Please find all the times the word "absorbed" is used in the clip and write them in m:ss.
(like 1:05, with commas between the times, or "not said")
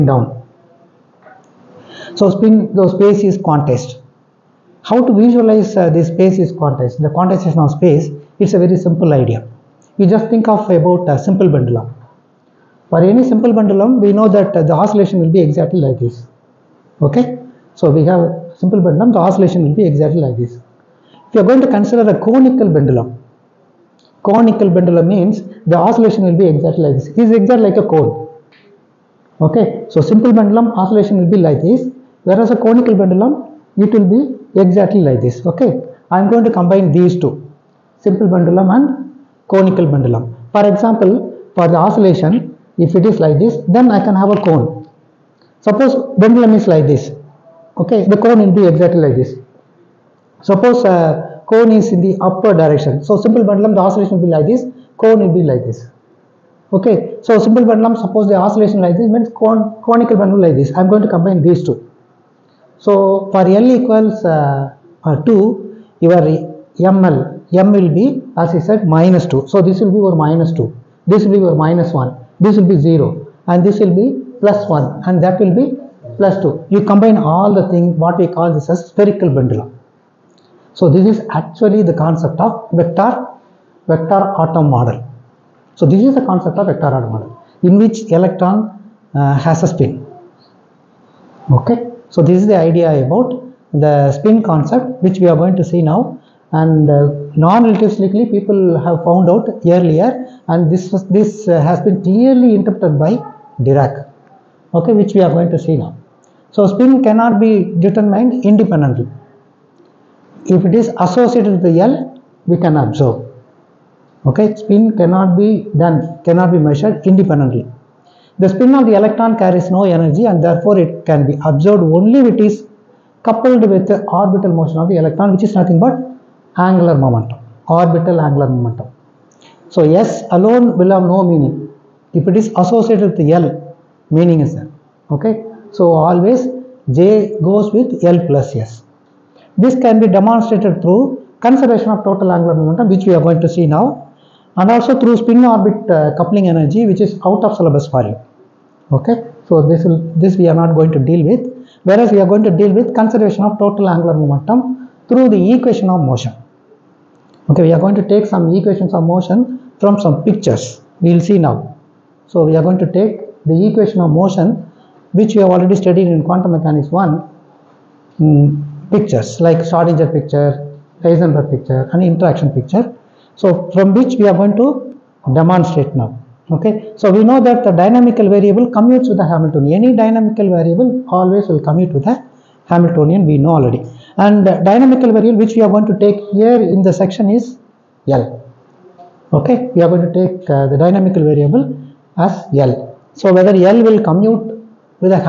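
2:01.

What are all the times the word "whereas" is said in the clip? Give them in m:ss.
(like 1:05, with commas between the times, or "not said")
0:32, 2:31.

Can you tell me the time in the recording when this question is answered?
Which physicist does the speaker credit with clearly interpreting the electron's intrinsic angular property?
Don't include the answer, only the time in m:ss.
1:43.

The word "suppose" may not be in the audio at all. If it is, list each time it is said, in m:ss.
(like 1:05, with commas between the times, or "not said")
0:45, 0:50, 0:58.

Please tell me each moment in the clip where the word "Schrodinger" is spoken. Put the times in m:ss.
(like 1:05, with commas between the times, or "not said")
2:49.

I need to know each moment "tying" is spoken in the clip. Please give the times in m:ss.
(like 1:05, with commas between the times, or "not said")
not said.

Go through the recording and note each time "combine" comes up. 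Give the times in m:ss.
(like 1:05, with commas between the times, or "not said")
0:36, 1:01, 1:16.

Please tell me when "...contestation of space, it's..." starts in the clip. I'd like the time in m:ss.
0:07.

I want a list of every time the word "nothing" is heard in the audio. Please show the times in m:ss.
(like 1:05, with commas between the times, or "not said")
2:05.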